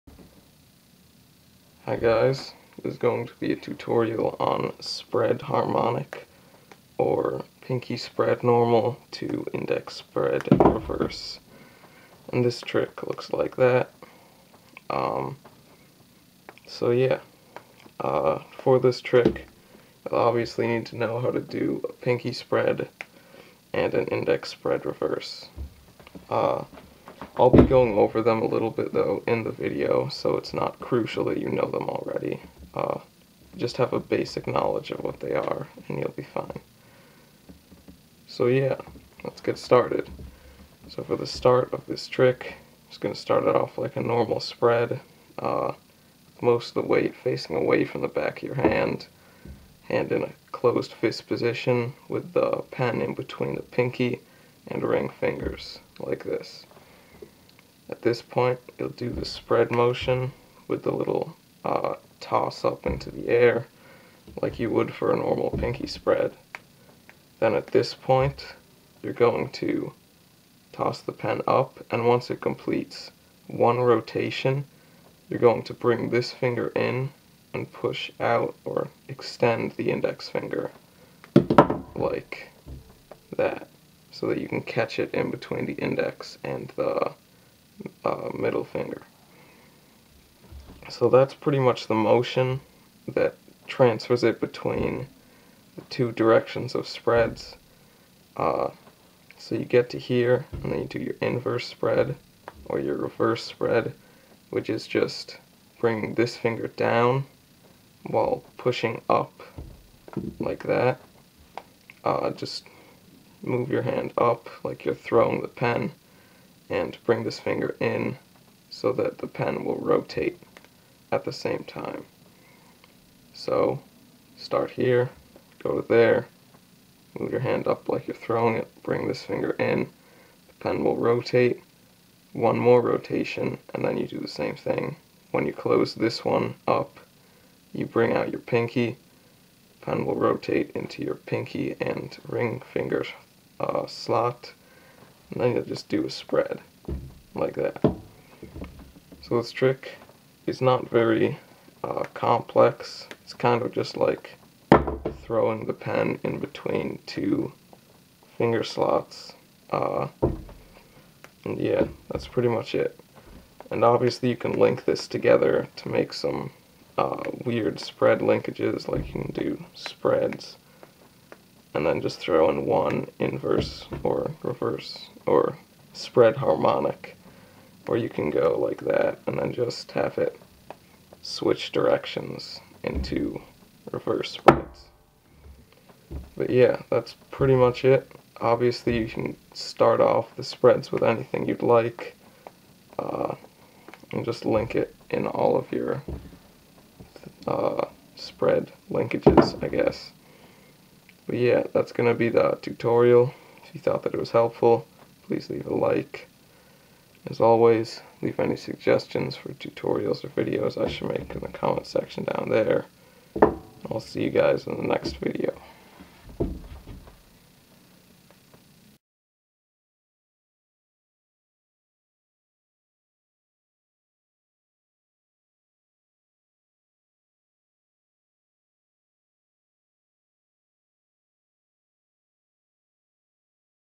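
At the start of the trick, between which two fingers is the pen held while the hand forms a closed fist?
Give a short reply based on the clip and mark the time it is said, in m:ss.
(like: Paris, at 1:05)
Pinky and ring fingers, at 0:53.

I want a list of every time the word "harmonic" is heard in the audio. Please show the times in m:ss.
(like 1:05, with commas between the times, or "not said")
0:05, 2:56.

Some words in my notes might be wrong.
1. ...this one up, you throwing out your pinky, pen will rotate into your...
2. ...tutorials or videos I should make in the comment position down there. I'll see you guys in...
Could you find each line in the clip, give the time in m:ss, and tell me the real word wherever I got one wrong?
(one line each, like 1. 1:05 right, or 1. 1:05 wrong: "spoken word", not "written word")
1. 2:15 wrong: "bring", not "throwing"
2. 3:29 wrong: "section", not "position".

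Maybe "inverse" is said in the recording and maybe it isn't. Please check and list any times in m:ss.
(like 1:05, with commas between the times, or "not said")
1:41, 2:53.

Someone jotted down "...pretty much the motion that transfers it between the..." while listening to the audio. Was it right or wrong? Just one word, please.
right.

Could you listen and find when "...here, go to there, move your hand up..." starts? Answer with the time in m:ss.
2:04.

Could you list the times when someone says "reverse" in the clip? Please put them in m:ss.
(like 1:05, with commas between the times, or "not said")
0:10, 0:24, 1:42, 2:54, 3:03.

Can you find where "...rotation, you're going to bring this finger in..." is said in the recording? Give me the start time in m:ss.
1:13.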